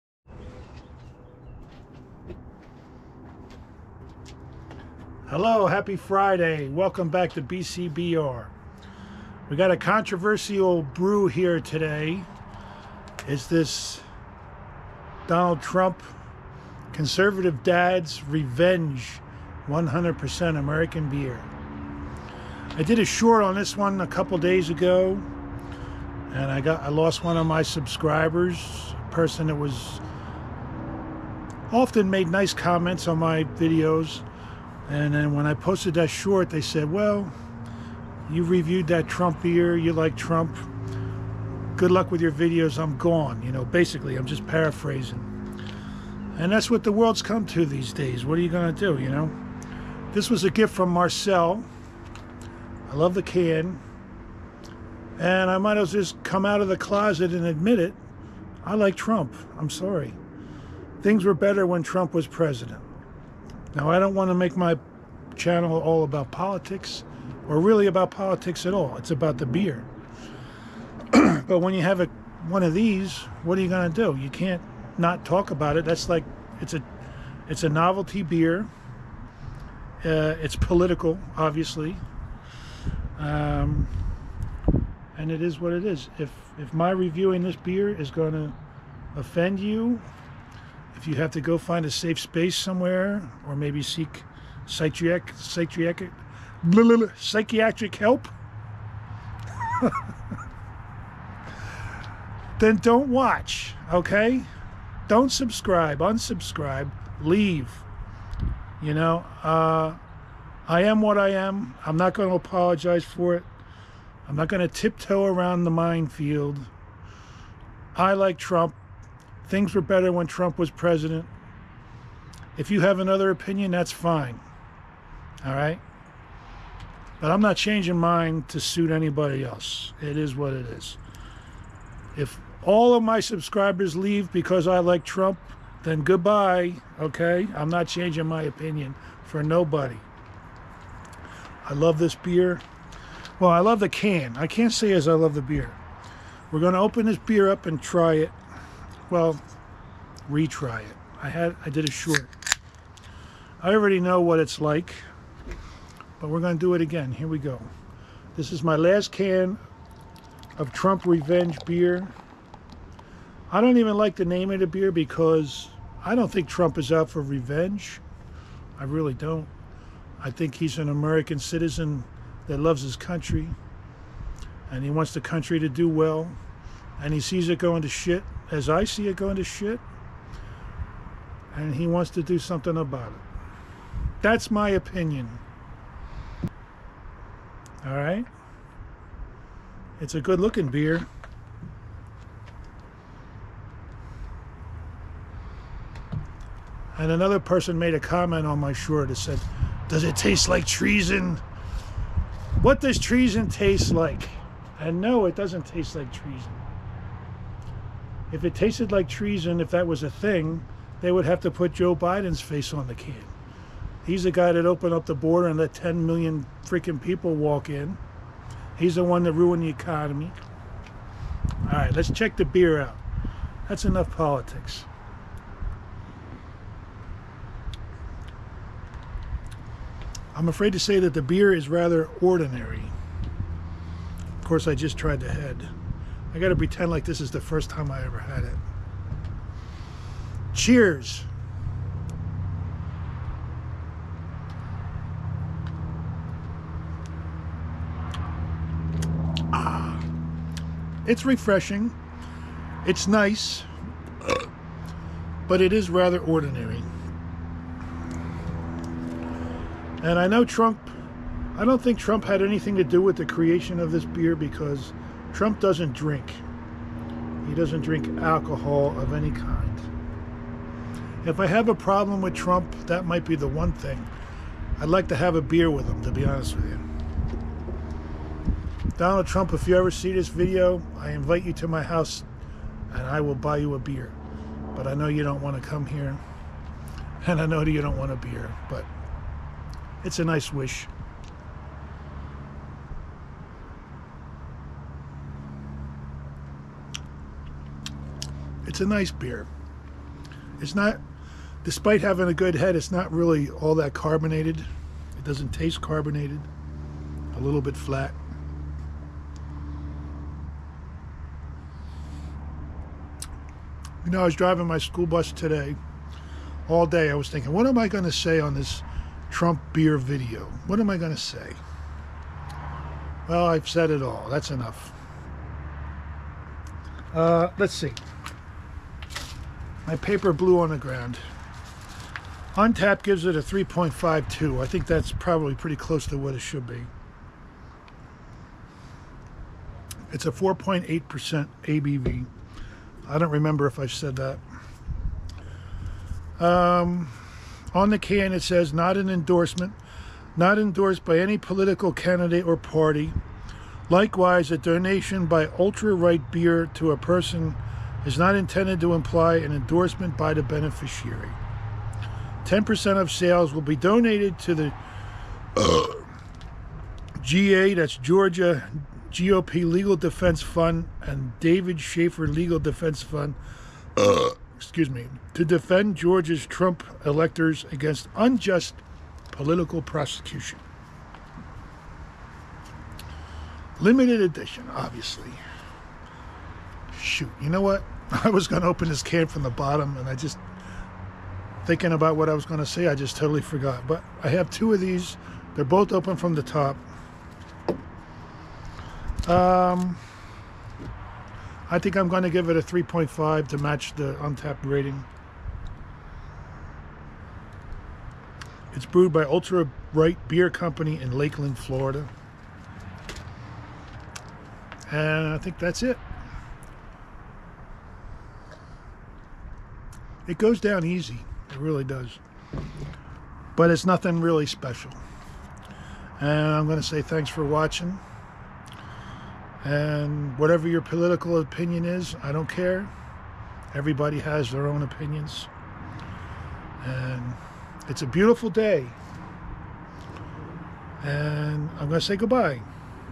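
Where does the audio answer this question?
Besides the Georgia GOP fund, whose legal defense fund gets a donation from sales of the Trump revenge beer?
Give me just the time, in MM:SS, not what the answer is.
06:11.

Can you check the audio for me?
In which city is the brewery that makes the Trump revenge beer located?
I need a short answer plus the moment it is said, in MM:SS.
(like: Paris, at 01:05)
Lakeland, Florida, at 06:51.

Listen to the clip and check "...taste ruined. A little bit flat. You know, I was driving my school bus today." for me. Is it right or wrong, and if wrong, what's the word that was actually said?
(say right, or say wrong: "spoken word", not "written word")
wrong: "carbonated", not "ruined".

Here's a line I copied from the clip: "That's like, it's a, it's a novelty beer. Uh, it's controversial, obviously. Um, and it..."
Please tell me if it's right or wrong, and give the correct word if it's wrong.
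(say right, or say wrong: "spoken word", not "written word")
wrong: "political", not "controversial".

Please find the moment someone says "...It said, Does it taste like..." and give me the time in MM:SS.
03:19.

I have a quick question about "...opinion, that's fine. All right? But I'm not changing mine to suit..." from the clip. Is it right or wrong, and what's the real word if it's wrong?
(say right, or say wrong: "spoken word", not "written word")
right.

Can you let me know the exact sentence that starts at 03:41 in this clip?
All right, let's check the beer out.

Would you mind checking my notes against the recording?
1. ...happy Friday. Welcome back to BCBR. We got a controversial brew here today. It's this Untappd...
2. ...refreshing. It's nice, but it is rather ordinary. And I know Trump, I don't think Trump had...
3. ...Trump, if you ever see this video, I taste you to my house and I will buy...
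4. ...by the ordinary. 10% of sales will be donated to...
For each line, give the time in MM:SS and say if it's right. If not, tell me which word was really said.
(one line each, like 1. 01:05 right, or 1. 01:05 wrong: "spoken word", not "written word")
1. 00:05 wrong: "Donald", not "Untappd"
2. 04:11 right
3. 04:39 wrong: "invite", not "taste"
4. 06:00 wrong: "beneficiary", not "ordinary".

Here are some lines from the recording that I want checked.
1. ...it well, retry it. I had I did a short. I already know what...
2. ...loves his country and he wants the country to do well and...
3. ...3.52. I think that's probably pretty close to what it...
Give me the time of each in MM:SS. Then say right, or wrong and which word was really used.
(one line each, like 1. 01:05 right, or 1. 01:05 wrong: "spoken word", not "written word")
1. 02:28 right
2. 02:52 right
3. 05:33 right.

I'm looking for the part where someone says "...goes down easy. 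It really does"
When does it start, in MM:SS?
07:00.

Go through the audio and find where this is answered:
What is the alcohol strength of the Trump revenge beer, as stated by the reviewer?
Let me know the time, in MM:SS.
05:40.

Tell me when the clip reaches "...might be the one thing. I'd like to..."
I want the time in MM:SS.
04:33.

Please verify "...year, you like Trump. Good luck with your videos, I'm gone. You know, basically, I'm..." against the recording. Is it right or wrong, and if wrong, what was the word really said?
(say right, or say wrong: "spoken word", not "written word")
right.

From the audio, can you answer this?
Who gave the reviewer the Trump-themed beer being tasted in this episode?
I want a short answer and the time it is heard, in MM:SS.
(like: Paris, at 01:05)
Marcel, at 00:50.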